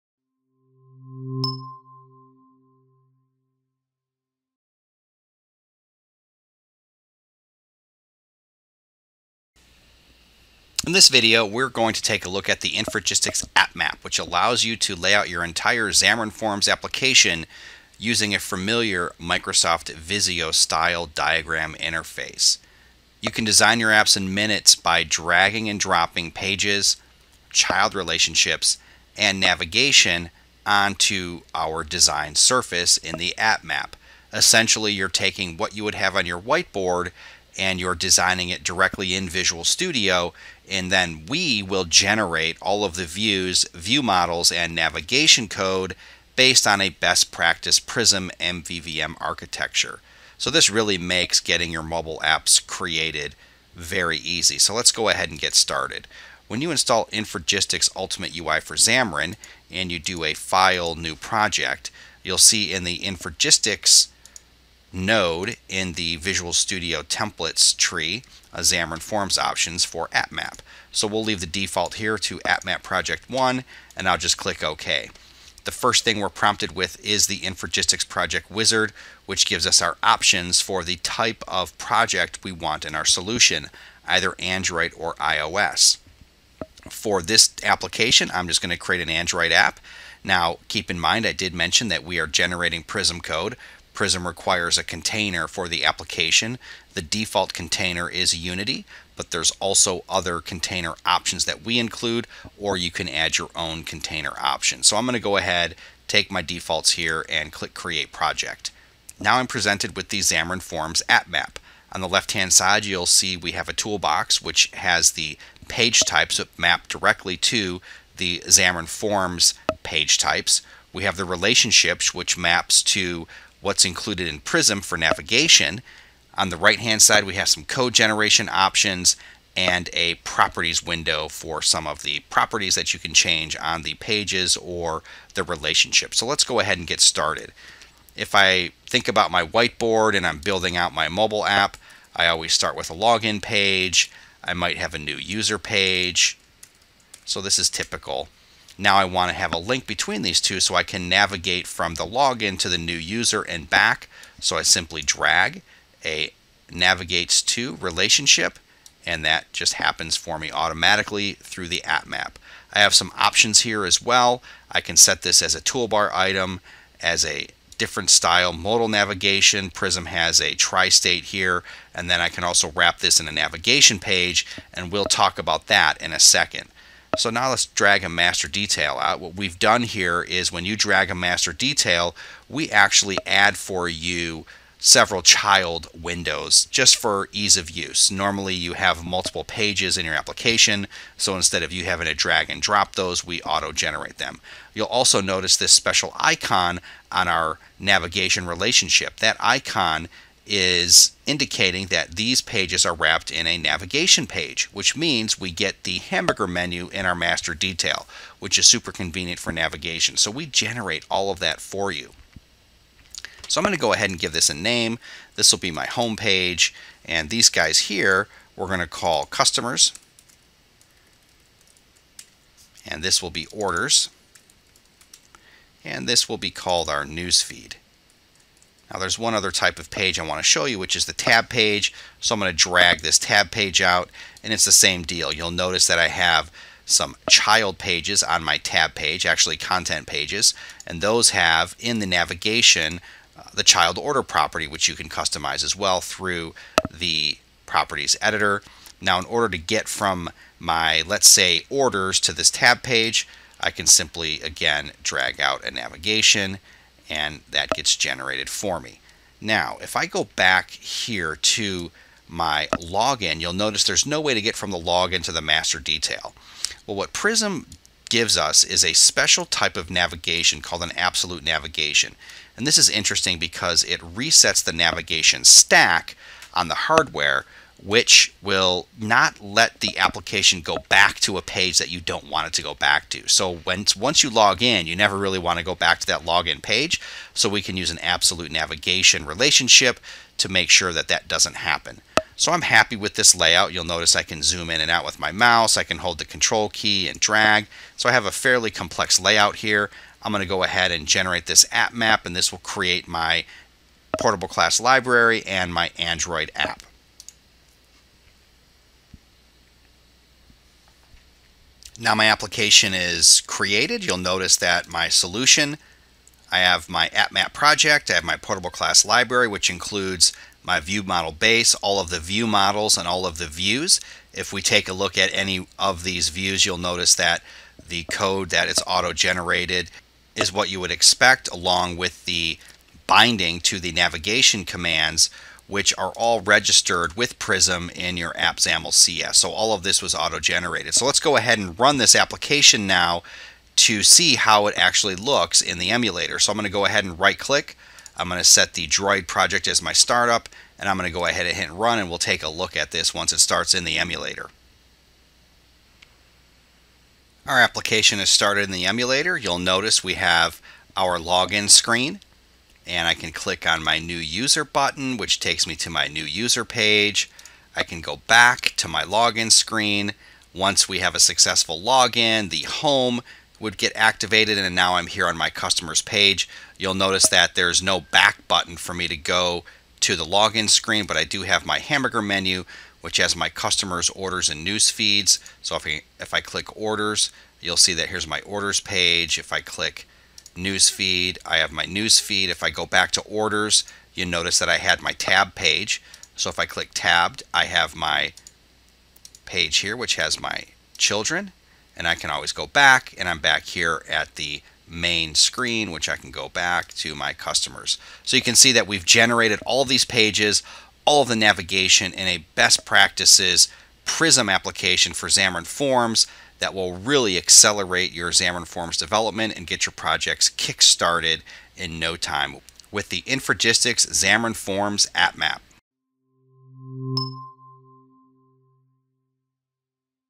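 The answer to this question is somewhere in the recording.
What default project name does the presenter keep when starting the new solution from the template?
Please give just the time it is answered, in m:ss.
1:12.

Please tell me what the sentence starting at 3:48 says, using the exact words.
Now there's one other type of page I want to show you, which is the tab page.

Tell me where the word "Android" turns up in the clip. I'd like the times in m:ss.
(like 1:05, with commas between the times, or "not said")
1:24, 1:29, 5:05.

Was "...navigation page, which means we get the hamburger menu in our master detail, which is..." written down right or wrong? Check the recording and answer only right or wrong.
right.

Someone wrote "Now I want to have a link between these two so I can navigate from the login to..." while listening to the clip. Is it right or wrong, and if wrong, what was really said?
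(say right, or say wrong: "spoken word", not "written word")
right.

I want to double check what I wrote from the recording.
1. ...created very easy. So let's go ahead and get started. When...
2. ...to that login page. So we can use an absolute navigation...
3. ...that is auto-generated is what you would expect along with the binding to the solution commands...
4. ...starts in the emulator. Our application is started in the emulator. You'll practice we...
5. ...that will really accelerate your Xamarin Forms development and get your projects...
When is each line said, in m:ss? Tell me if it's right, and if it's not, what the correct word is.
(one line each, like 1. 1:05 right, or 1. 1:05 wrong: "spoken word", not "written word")
1. 0:52 right
2. 4:45 right
3. 5:28 wrong: "navigation", not "solution"
4. 5:53 wrong: "notice", not "practice"
5. 6:56 right.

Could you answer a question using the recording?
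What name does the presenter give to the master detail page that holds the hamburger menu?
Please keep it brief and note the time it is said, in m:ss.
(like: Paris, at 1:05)
home page, at 3:35.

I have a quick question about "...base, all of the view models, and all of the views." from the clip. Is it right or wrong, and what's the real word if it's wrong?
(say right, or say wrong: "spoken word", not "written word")
right.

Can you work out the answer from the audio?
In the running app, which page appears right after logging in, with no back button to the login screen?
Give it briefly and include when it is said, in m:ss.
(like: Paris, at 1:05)
customers page, at 6:15.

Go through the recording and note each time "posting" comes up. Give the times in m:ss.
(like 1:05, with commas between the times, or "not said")
not said.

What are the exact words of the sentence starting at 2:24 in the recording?
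I might have a new user page.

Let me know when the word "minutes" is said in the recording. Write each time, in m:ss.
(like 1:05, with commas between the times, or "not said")
0:24.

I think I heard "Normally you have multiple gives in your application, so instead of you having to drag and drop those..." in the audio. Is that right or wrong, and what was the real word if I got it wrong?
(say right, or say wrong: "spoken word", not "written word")
wrong: "pages", not "gives".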